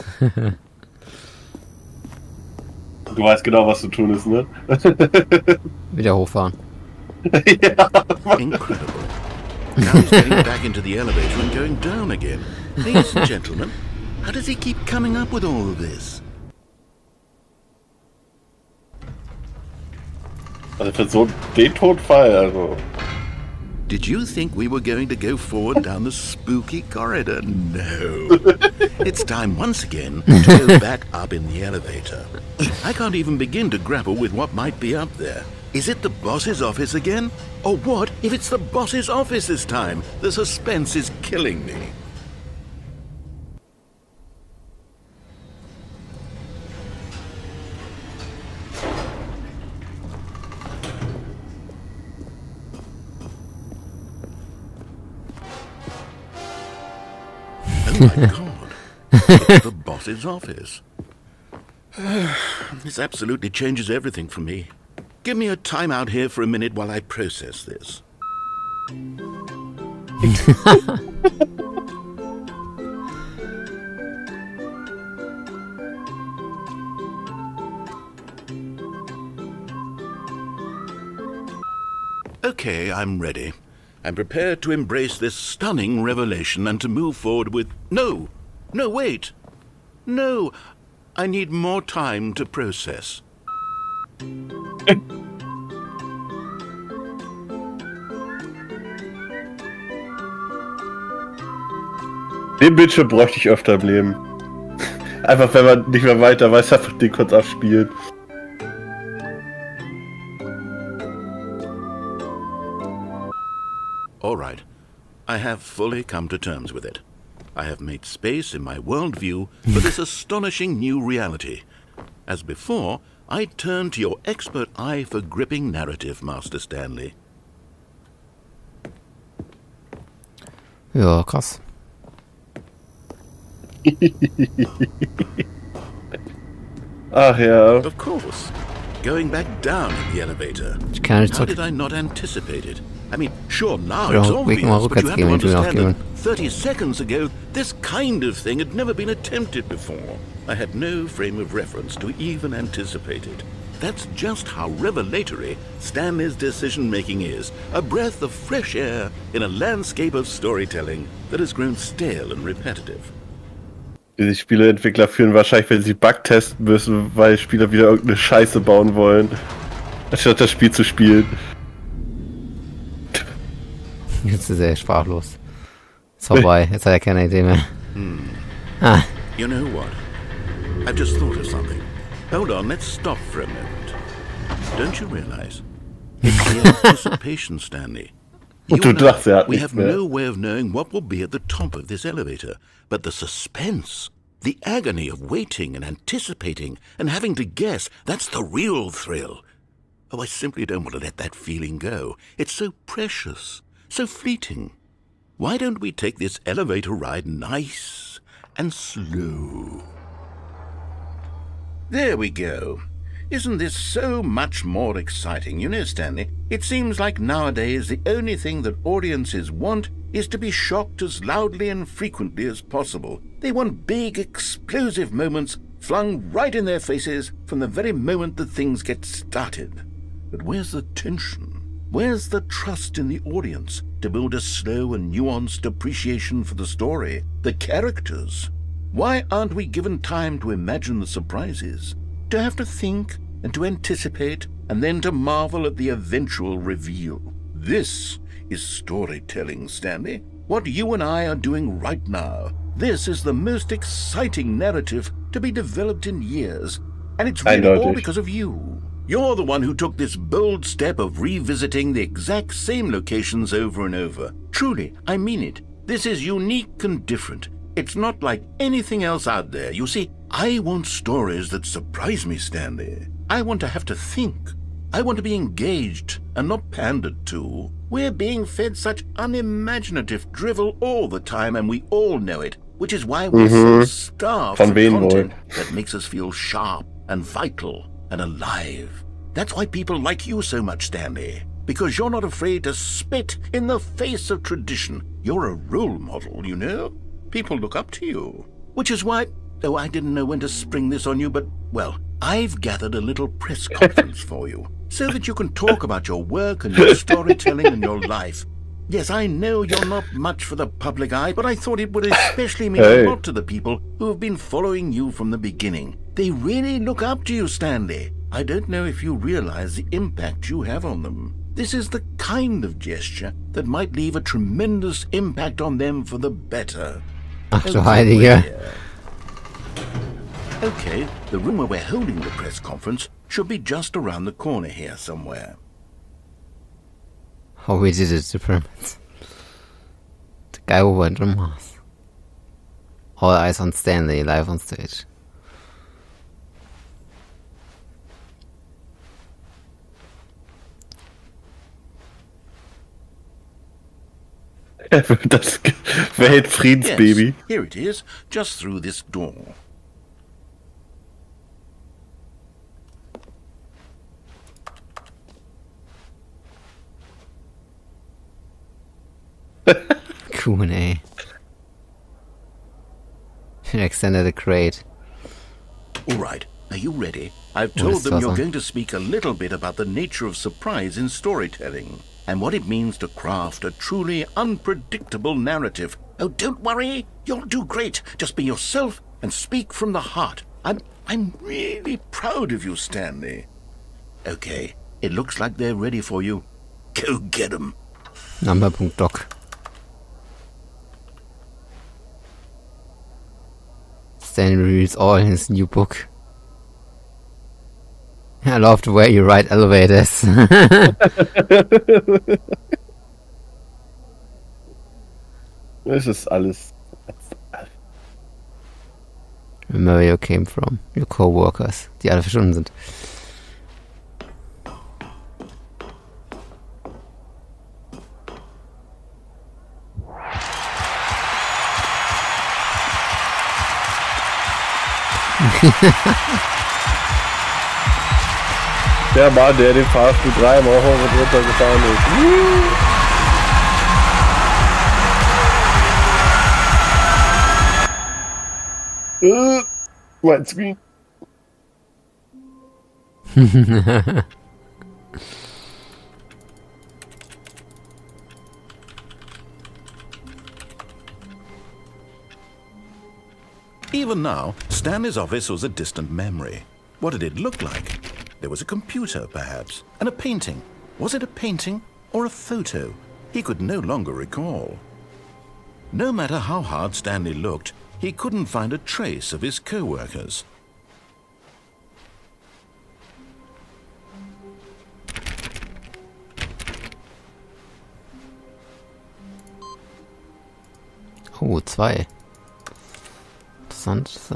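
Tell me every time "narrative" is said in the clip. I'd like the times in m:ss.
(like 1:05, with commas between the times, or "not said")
2:05, 4:14, 6:25.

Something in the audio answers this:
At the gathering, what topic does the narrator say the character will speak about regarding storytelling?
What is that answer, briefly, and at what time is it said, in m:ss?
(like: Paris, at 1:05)
the nature of surprise, at 6:19.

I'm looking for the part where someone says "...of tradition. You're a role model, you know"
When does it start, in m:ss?
4:54.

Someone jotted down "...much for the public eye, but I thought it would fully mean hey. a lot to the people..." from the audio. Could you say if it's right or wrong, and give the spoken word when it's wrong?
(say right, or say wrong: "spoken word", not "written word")
wrong: "especially", not "fully".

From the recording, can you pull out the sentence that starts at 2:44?
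Die Spieleentwickler führen wahrscheinlich, wenn sie Bug testen müssen, weil Spieler wieder irgendeine Scheiße bauen wollen, anstatt das Spiel zu spielen.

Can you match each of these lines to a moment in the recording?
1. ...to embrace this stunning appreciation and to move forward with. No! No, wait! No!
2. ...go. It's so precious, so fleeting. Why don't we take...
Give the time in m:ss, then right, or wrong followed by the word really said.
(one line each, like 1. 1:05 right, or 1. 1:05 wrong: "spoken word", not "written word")
1. 1:24 wrong: "revelation", not "appreciation"
2. 3:21 right.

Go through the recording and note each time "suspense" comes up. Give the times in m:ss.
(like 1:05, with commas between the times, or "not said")
0:40, 3:13.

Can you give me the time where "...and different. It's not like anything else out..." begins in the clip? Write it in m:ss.
4:26.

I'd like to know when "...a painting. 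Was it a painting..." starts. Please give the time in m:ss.
7:50.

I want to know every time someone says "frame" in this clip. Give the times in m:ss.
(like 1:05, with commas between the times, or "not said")
2:31.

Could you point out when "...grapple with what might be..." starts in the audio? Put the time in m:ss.
0:33.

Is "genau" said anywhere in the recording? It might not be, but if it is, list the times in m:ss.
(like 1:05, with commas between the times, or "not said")
0:03.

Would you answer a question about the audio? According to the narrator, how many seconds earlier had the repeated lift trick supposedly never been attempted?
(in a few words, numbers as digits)
30.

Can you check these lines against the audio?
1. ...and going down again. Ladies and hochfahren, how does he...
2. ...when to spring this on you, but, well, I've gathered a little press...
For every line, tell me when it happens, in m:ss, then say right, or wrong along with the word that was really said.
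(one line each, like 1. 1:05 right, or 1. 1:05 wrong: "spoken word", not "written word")
1. 0:11 wrong: "gentlemen", not "hochfahren"
2. 5:00 right.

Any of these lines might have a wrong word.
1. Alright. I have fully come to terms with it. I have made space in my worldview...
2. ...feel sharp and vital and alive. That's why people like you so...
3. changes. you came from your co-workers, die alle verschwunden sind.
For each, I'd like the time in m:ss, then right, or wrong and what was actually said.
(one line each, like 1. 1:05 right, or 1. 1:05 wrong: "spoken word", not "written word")
1. 1:54 right
2. 4:46 right
3. 6:56 wrong: "alles", not "changes".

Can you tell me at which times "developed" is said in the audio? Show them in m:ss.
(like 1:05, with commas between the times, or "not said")
4:15.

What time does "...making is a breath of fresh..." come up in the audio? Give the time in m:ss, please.
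2:36.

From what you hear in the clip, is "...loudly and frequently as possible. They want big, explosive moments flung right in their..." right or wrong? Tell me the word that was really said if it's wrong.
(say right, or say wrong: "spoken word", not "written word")
right.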